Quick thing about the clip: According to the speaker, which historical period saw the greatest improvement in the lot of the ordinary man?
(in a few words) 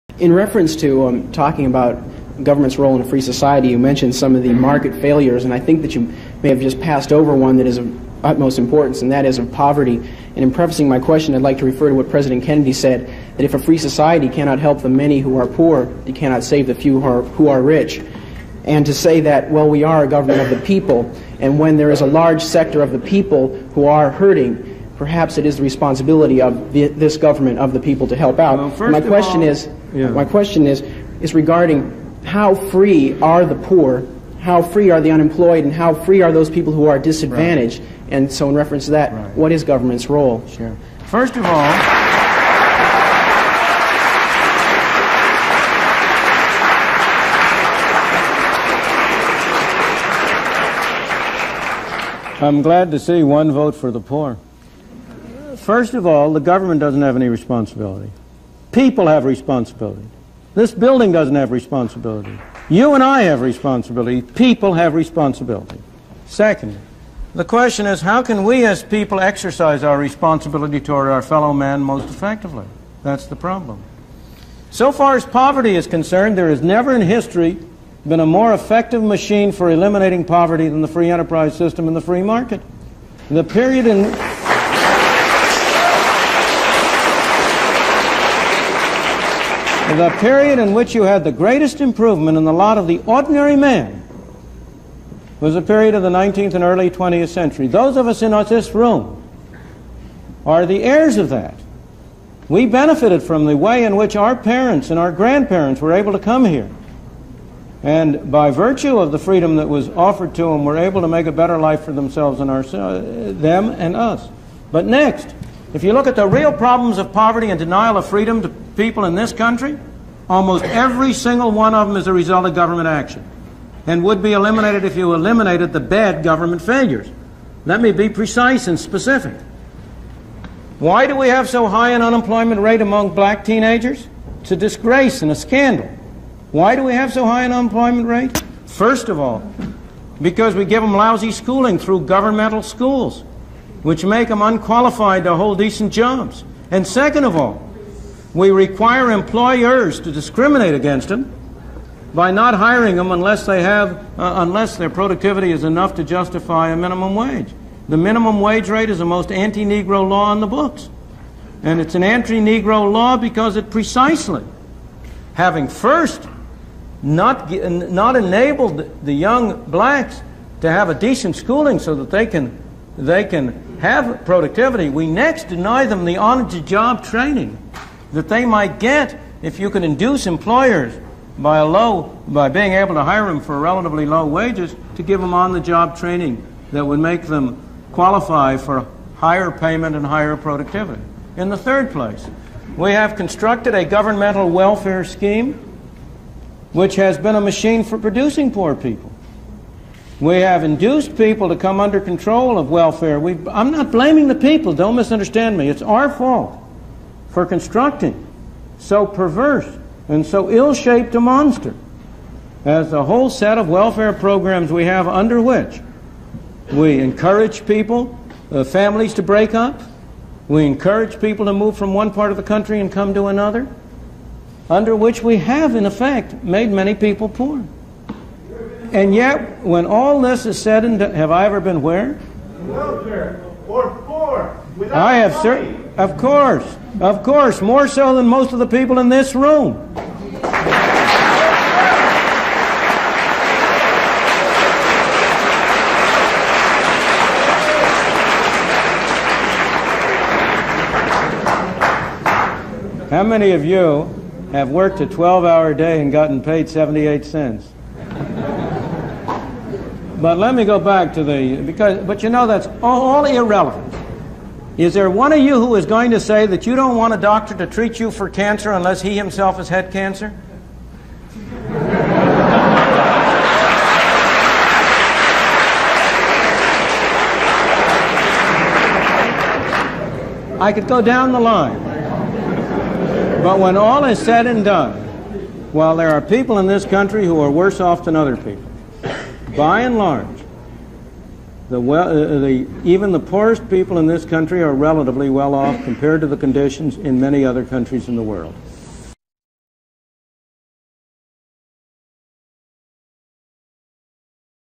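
19th and early 20th century.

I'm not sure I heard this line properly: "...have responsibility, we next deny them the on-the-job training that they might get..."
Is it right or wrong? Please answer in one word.
wrong.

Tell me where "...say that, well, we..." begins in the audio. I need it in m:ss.
0:18.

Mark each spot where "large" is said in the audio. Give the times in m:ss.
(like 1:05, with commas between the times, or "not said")
0:22, 4:49.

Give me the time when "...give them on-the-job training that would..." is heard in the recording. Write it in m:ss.
3:05.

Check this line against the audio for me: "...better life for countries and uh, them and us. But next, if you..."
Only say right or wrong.
wrong.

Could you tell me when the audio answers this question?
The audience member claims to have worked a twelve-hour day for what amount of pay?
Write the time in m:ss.
4:16.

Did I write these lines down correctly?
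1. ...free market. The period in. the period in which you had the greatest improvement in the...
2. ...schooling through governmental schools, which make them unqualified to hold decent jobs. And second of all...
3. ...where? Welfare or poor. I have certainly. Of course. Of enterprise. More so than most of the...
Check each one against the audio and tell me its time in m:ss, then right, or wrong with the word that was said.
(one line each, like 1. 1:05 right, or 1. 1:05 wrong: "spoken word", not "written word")
1. 1:22 right
2. 2:21 right
3. 3:51 wrong: "course", not "enterprise".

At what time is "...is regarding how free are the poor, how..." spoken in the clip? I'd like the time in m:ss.
0:31.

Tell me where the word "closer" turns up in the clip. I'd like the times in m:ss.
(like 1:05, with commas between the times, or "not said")
not said.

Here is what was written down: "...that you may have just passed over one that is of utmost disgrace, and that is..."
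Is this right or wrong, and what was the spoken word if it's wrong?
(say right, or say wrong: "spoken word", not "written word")
wrong: "importance", not "disgrace".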